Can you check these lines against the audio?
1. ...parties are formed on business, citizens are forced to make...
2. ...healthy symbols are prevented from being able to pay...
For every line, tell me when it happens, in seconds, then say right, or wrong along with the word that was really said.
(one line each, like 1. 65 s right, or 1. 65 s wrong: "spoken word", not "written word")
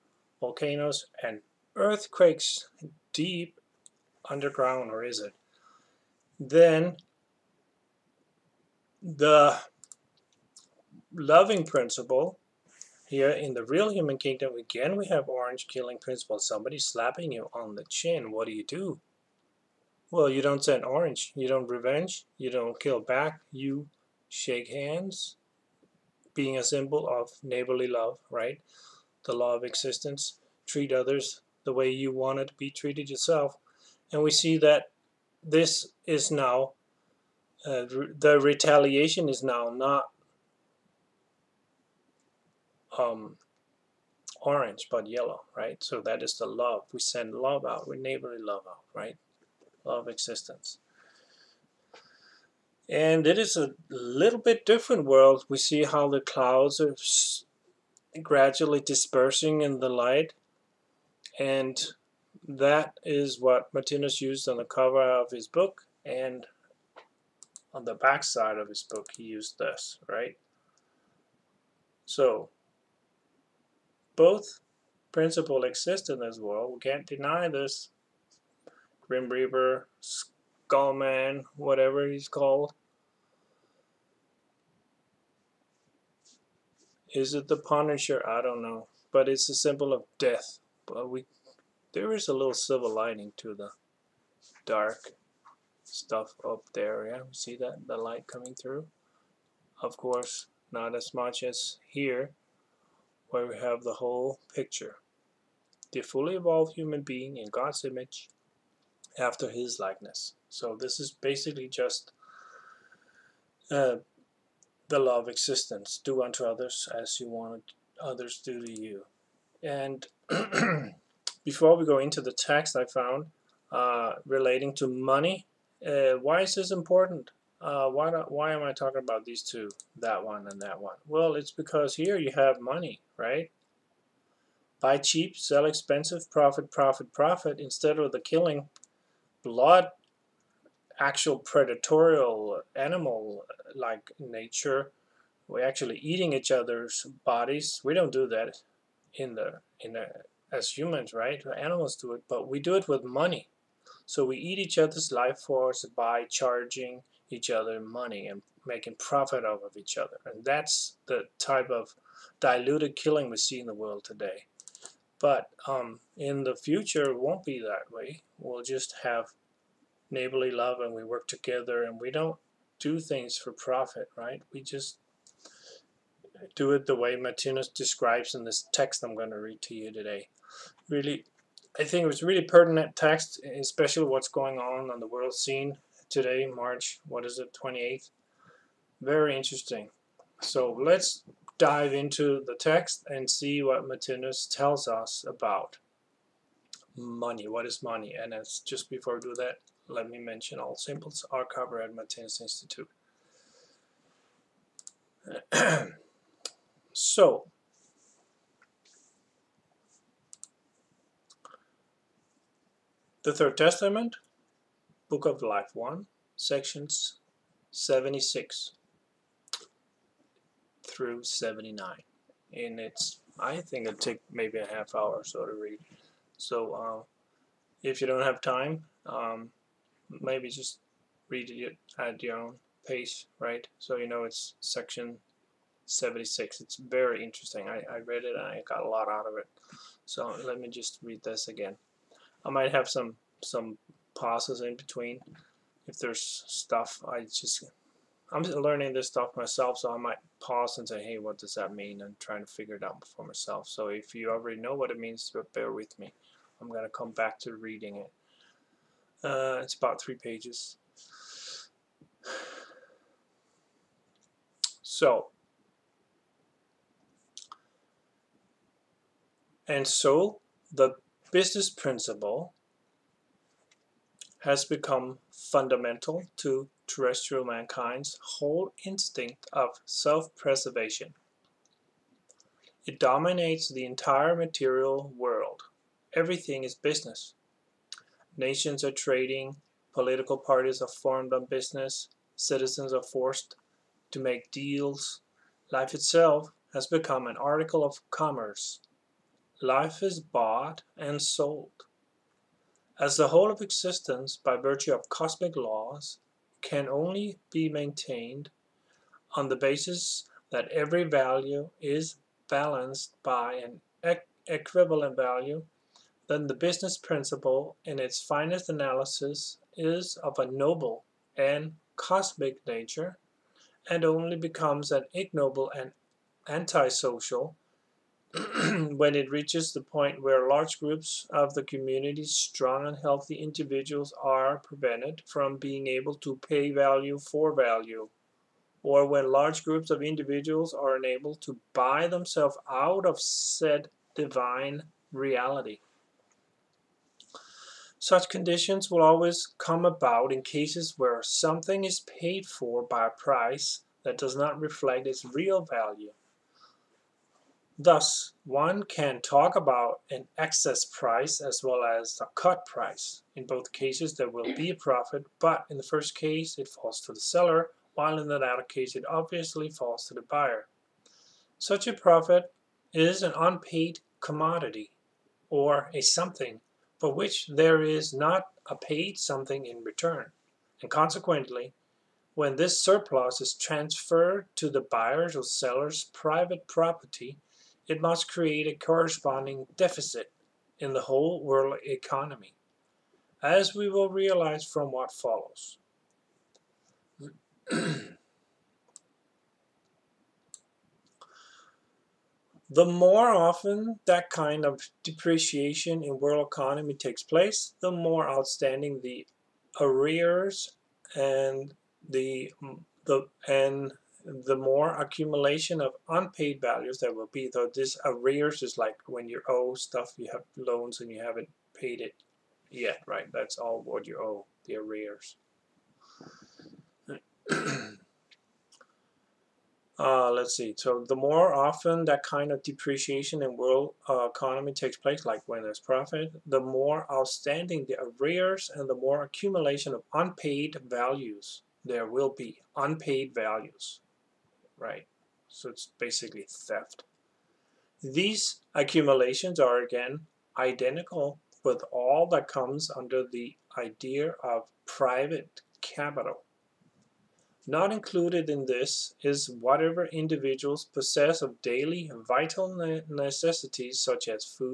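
1. 290 s right
2. 333 s wrong: "individuals", not "symbols".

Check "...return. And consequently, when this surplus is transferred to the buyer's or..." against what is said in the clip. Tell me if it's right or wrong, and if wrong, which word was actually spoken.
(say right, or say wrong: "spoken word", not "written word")
right.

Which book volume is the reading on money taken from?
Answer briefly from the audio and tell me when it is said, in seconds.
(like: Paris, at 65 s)
Book of Life 1, at 215 s.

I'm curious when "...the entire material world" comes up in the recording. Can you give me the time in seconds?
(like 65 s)
283 s.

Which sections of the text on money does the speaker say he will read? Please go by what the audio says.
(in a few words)
76 through 79.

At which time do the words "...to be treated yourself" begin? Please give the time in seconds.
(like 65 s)
32 s.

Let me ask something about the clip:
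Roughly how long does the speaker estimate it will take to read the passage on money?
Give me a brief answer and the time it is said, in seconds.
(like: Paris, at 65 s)
half hour, at 224 s.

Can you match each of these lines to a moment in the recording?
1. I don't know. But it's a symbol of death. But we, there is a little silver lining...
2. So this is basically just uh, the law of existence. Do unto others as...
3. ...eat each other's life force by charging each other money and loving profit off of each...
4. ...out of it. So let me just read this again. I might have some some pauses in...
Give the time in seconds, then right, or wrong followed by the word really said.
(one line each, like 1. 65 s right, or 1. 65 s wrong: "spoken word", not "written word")
1. 88 s right
2. 110 s right
3. 154 s wrong: "making", not "loving"
4. 239 s right.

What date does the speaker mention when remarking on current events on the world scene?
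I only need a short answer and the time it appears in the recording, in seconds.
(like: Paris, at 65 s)
March 28th, at 186 s.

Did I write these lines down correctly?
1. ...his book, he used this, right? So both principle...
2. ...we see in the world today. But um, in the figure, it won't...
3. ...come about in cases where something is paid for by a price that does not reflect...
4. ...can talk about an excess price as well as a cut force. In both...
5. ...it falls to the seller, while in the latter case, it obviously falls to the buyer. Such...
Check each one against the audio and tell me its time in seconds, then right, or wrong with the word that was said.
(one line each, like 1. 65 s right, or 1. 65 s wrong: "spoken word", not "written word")
1. 68 s right
2. 163 s wrong: "future", not "figure"
3. 349 s right
4. 358 s wrong: "price", not "force"
5. 366 s right.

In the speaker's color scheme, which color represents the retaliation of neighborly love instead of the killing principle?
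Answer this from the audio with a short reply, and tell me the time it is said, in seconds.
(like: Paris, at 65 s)
yellow, at 45 s.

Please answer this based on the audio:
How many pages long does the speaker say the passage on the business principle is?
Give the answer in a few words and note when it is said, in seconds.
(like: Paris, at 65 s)
3, at 260 s.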